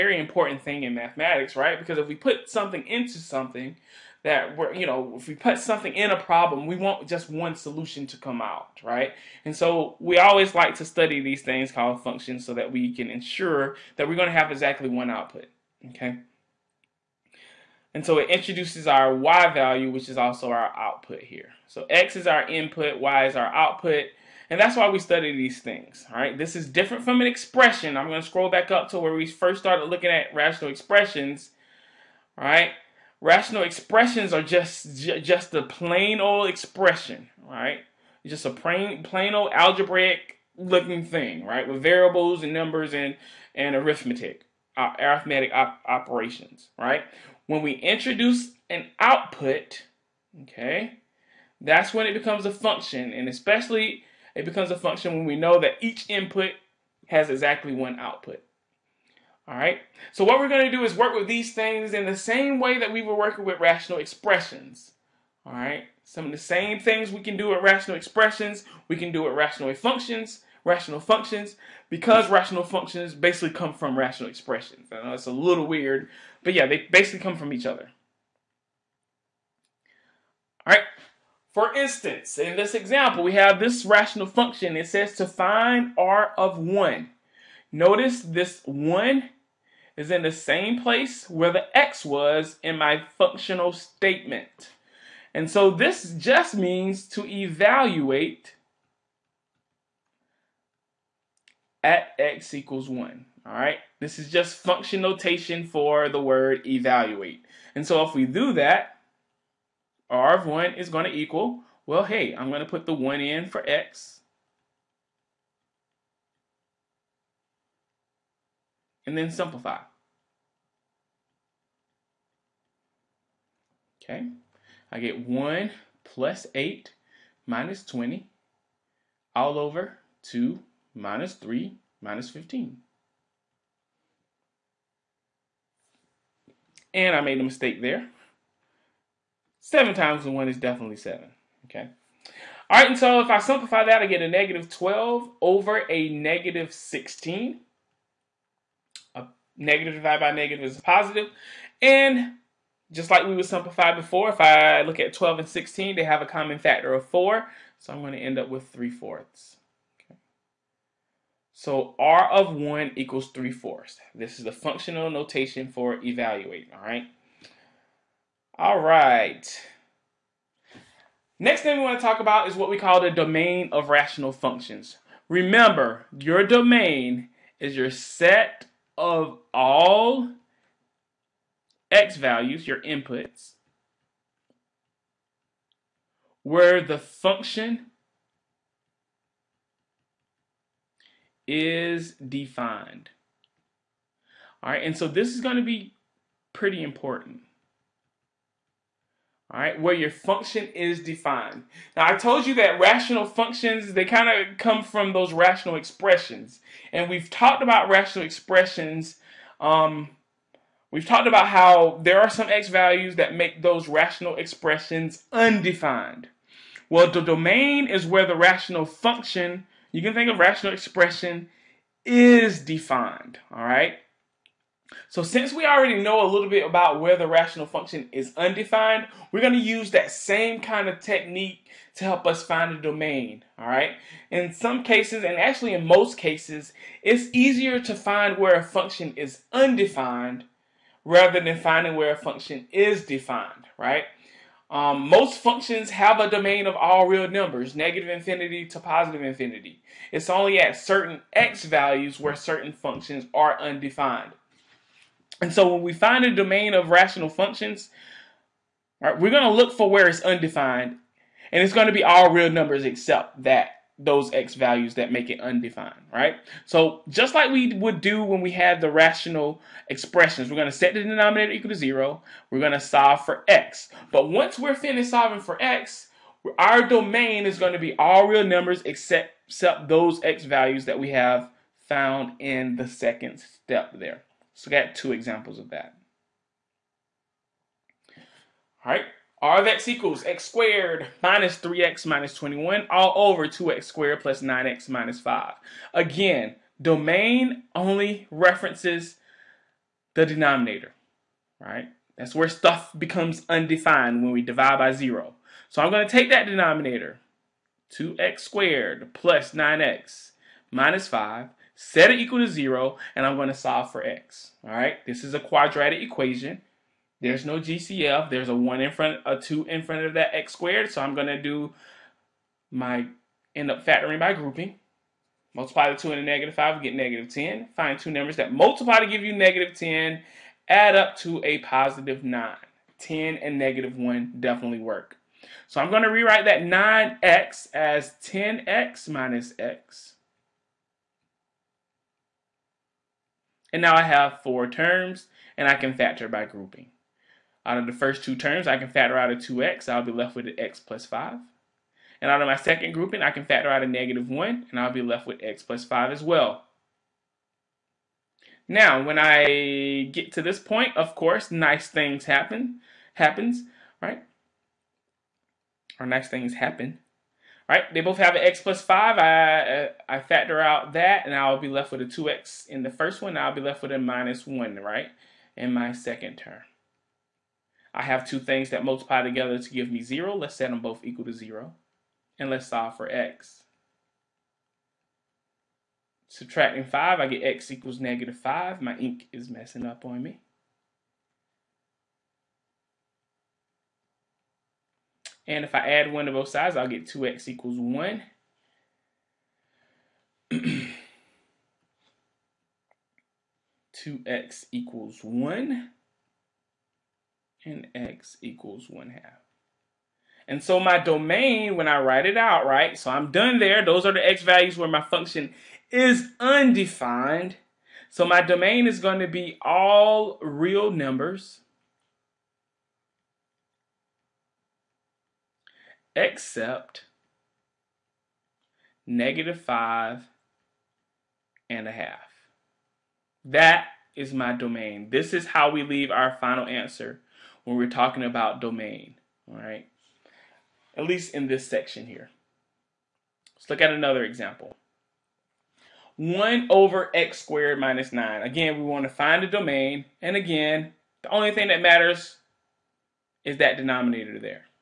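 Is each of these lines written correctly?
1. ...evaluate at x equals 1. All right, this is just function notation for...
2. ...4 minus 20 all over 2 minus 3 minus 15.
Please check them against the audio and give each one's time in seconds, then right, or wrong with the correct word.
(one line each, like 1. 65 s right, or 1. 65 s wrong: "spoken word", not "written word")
1. 97 s right
2. 126 s wrong: "8", not "4".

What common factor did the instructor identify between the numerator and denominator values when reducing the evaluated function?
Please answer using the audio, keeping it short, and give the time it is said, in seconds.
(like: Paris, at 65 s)
4, at 156 s.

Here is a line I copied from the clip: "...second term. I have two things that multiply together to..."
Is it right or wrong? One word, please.
right.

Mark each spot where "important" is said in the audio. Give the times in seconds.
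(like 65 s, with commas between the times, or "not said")
0 s, 196 s.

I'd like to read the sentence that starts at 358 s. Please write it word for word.
Now, when I get to this point, of course, nice things happen, happens, right?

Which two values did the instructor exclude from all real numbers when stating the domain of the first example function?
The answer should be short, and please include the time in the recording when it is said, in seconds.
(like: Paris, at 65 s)
-5 and 1/2, at 429 s.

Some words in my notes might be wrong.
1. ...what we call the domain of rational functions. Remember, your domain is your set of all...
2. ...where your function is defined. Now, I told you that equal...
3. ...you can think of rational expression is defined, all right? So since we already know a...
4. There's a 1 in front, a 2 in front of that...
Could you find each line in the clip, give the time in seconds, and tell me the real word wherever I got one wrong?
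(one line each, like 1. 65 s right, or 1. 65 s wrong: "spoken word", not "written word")
1. 172 s right
2. 199 s wrong: "rational", not "equal"
3. 219 s right
4. 318 s right.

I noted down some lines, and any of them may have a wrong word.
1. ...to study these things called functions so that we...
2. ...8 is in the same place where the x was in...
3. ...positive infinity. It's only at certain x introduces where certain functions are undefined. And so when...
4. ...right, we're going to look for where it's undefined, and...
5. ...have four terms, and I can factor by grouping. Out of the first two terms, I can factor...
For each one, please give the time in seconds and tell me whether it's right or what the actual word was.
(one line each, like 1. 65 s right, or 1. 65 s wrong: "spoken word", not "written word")
1. 10 s right
2. 88 s wrong: "1", not "8"
3. 248 s wrong: "values", not "introduces"
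4. 259 s right
5. 344 s right.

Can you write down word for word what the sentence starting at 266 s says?
So just like we would do when we had the rational expressions, we're going to set the denominator equal to 0.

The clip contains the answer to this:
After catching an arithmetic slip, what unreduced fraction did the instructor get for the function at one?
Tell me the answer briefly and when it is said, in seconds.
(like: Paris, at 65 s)
-12/-16, at 144 s.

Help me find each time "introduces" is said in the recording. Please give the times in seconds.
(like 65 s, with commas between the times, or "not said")
18 s, 47 s.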